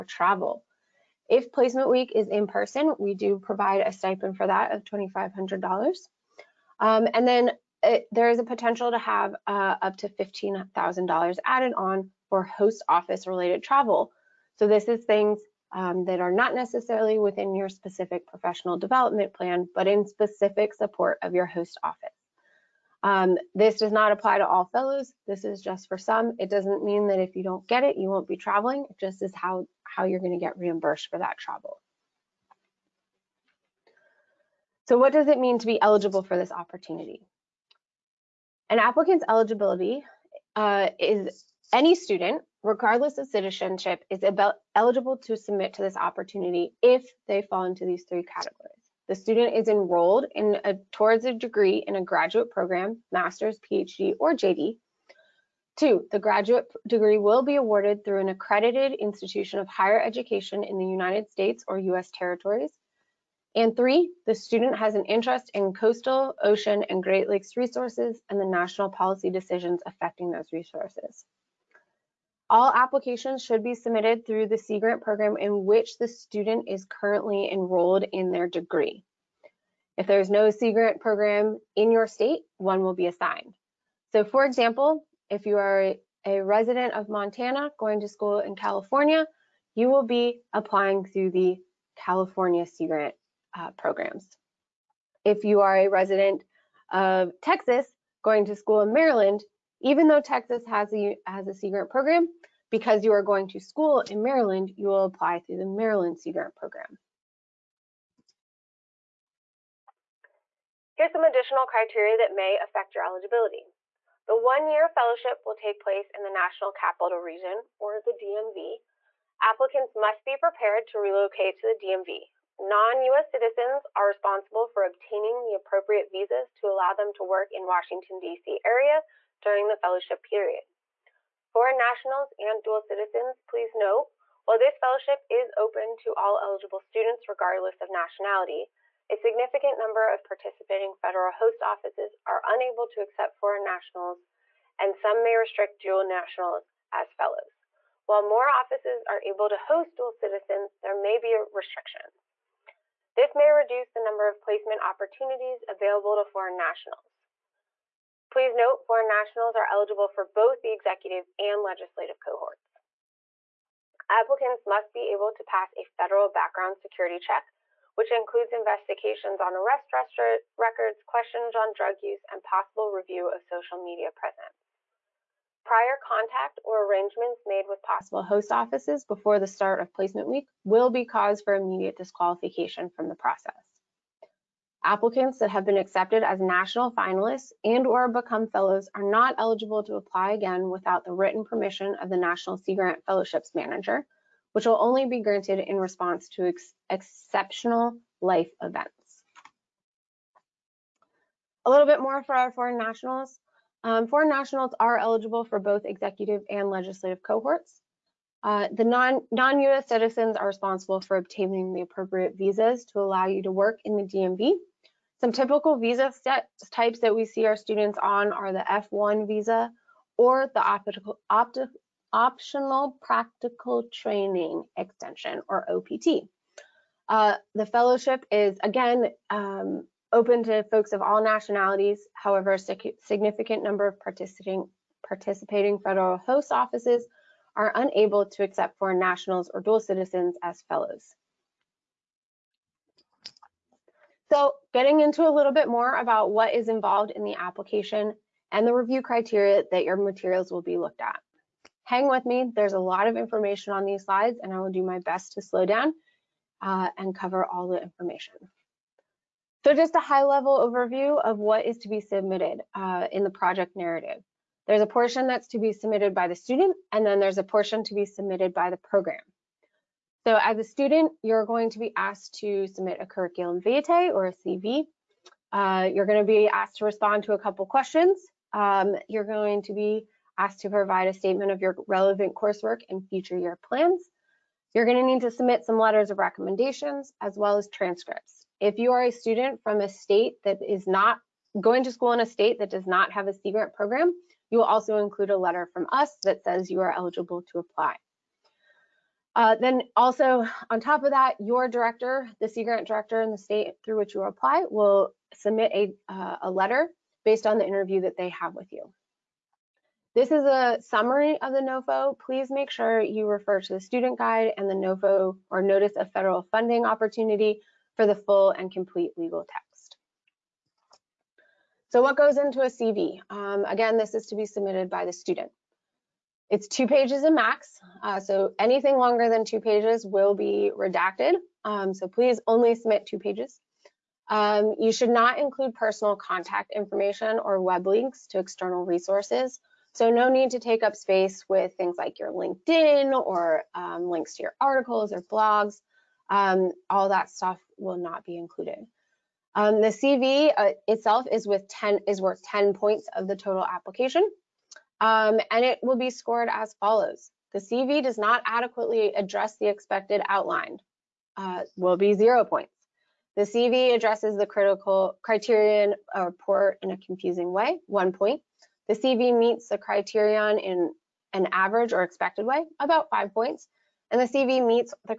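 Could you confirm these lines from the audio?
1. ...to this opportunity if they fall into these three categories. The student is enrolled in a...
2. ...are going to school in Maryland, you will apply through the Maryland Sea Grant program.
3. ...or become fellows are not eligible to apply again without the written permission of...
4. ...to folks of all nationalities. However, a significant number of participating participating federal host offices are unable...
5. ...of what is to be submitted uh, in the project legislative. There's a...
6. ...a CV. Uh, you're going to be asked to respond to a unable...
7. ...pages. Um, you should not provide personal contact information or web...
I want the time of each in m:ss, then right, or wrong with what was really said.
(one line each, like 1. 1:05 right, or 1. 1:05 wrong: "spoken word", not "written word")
1. 0:45 right
2. 1:43 right
3. 3:07 right
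4. 3:50 right
5. 4:21 wrong: "narrative", not "legislative"
6. 4:34 wrong: "couple", not "unable"
7. 5:33 wrong: "include", not "provide".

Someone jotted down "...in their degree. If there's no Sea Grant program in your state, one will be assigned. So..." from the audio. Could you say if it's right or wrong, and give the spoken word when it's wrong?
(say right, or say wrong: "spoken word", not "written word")
right.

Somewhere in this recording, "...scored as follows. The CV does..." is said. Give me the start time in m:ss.
5:56.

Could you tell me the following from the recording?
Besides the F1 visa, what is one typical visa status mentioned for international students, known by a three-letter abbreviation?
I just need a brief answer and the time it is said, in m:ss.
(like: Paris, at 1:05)
OPT, at 3:45.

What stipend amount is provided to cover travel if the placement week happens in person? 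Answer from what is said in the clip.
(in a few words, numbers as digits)
$2,500.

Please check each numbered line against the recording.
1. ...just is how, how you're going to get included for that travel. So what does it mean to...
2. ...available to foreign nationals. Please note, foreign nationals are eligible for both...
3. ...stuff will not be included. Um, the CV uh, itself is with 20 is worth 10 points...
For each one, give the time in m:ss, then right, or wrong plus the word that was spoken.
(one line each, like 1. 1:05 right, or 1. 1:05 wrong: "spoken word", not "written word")
1. 0:28 wrong: "reimbursed", not "included"
2. 2:35 right
3. 5:47 wrong: "10", not "20".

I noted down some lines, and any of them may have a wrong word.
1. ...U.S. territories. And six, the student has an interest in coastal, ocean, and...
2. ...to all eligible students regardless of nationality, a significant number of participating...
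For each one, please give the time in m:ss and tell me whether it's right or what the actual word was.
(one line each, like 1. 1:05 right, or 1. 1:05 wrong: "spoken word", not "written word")
1. 1:01 wrong: "three", not "six"
2. 2:15 right.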